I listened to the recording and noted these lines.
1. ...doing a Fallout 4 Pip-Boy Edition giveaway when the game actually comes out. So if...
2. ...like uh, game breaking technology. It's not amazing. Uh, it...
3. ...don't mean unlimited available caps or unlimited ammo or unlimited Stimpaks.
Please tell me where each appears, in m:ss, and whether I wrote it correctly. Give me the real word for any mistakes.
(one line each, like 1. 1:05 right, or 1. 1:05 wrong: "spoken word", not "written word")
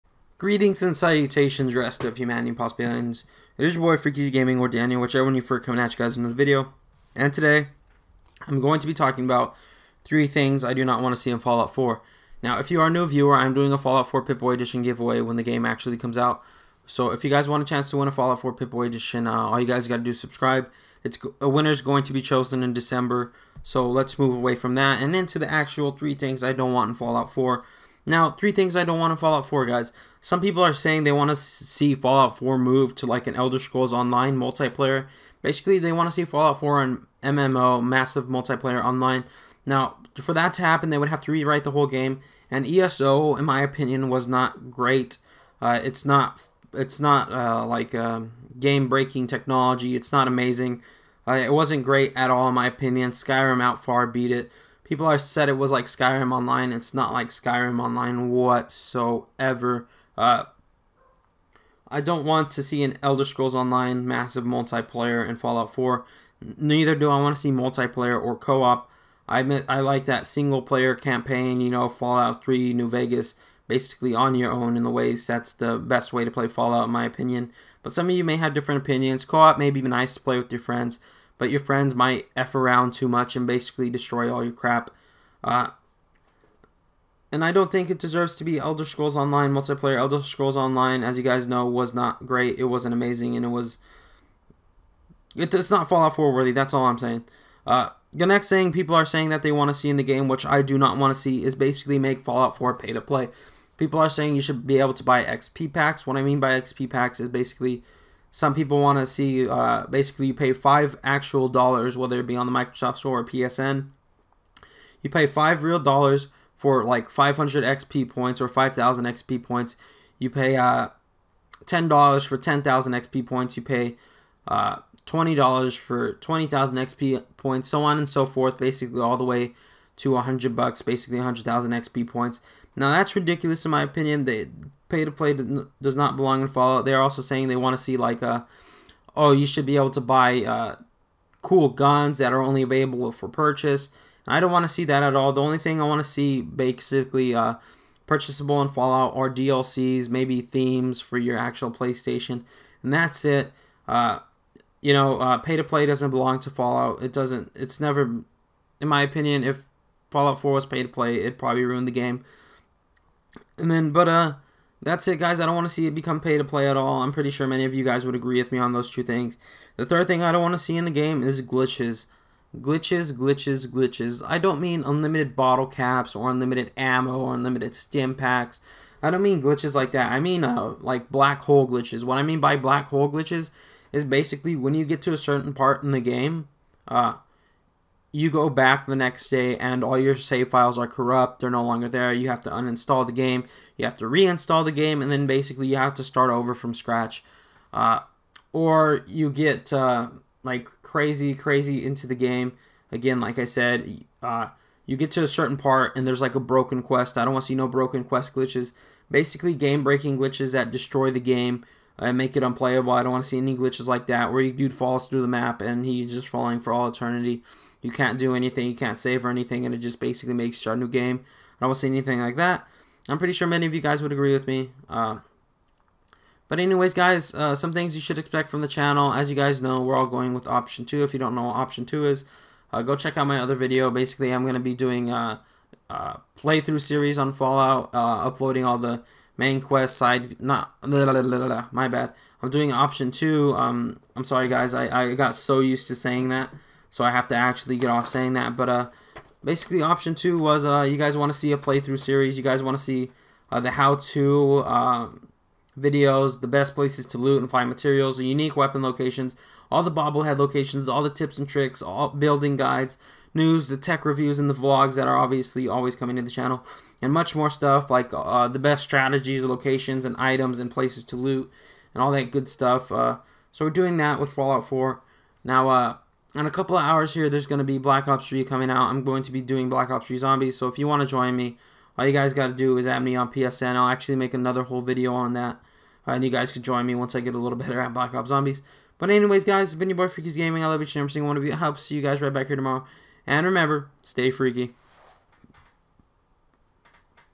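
1. 0:13 right
2. 0:47 right
3. 2:54 wrong: "bottle", not "available".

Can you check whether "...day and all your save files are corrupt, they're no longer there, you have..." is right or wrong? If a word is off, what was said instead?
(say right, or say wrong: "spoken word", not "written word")
right.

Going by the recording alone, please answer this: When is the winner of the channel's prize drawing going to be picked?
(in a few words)
December.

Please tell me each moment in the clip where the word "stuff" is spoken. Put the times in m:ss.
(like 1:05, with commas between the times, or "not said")
4:27, 4:32.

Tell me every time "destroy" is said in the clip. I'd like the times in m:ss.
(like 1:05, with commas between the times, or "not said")
1:23, 3:30.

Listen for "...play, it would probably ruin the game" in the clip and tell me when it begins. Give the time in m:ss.
2:40.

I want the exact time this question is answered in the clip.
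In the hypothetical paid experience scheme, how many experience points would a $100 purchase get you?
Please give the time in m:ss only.
2:11.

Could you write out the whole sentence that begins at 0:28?
Now, three things I don't want to Fallout 4, guys.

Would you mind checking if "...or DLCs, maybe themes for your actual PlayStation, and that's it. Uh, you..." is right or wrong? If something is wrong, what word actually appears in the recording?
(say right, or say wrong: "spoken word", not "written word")
right.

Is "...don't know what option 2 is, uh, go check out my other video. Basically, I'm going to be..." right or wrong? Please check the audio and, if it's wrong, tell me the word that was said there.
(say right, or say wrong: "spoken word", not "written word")
right.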